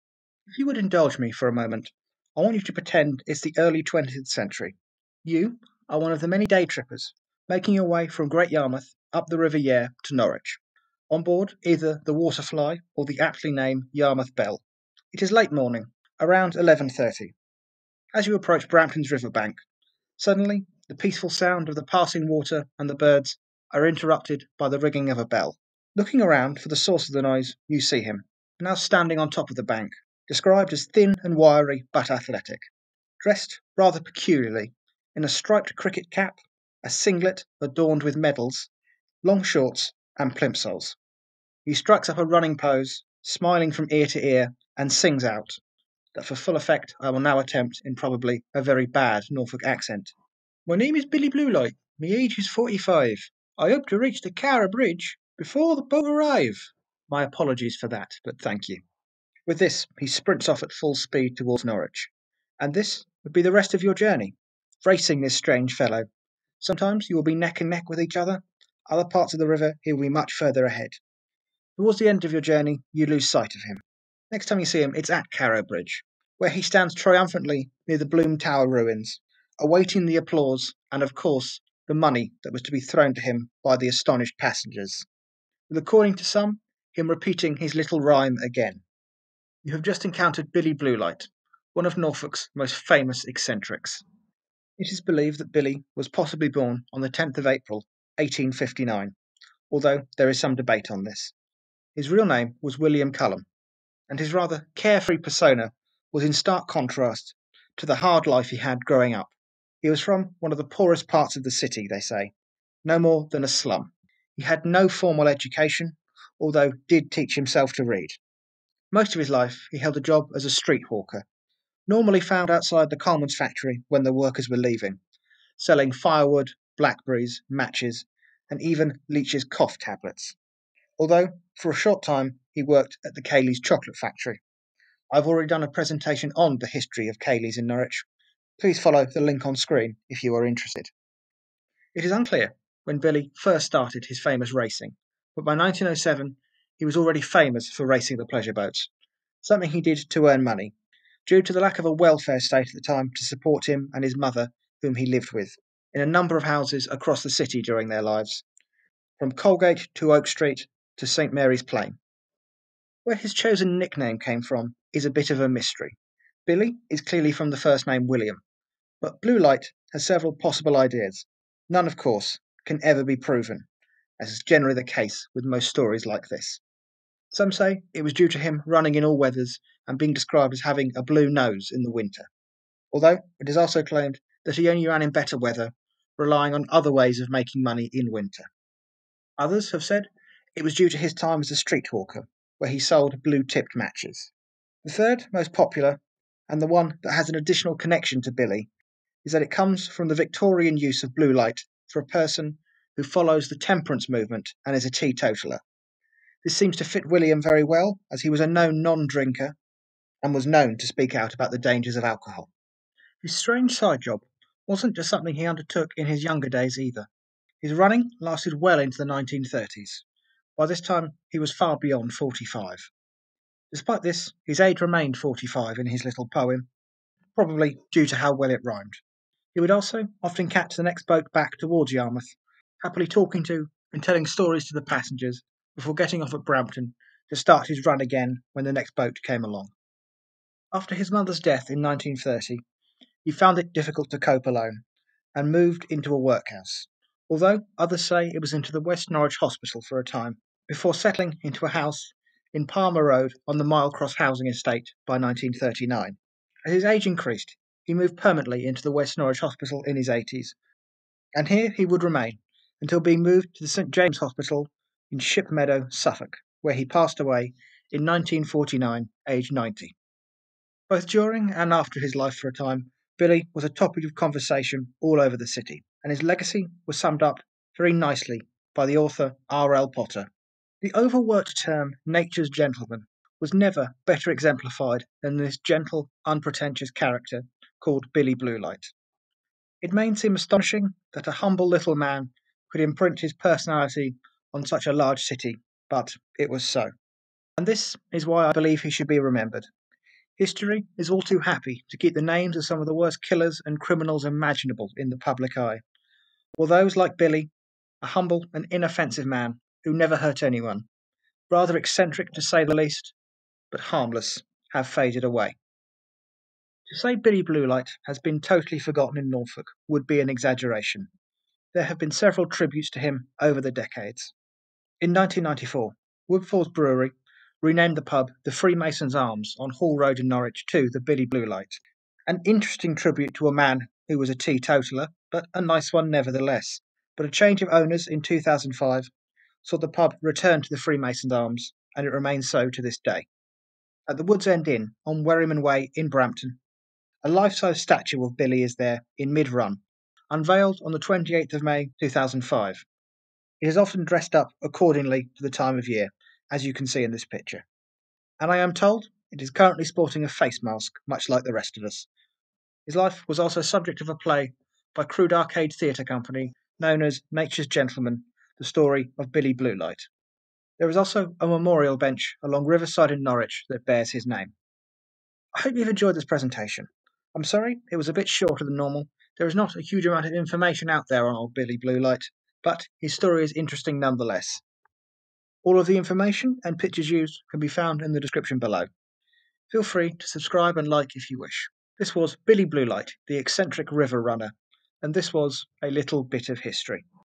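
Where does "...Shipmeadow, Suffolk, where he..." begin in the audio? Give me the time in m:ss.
4:25.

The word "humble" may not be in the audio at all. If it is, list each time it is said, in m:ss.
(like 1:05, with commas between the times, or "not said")
4:51, 5:08.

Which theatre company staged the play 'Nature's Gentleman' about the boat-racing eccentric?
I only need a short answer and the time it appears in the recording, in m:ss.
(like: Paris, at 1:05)
Crude Arcade, at 6:05.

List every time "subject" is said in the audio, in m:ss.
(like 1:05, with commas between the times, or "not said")
6:03.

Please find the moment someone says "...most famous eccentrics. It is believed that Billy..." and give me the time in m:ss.
1:32.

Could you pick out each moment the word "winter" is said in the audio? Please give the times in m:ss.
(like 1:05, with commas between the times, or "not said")
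3:01, 3:08.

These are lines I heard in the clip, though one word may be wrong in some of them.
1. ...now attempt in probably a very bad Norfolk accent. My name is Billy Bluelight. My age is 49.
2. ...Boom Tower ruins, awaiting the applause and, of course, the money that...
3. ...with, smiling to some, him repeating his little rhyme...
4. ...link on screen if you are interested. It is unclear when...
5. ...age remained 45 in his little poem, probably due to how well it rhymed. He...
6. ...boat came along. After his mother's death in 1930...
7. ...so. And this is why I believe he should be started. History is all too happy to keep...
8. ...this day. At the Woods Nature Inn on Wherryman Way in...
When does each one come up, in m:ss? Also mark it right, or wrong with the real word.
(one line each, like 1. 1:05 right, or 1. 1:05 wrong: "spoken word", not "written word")
1. 0:47 wrong: "45", not "49"
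2. 1:18 right
3. 1:25 wrong: "according", not "smiling"
4. 2:19 right
5. 3:44 right
6. 3:58 right
7. 4:56 wrong: "remembered", not "started"
8. 5:42 wrong: "End", not "Nature".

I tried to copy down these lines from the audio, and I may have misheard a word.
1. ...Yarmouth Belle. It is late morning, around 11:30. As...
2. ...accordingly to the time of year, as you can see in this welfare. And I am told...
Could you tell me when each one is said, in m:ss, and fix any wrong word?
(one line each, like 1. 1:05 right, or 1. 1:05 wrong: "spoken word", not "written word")
1. 0:13 right
2. 5:54 wrong: "picture", not "welfare".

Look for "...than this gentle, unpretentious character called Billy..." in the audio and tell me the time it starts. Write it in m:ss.
4:45.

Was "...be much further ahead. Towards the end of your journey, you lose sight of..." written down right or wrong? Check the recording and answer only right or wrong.
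right.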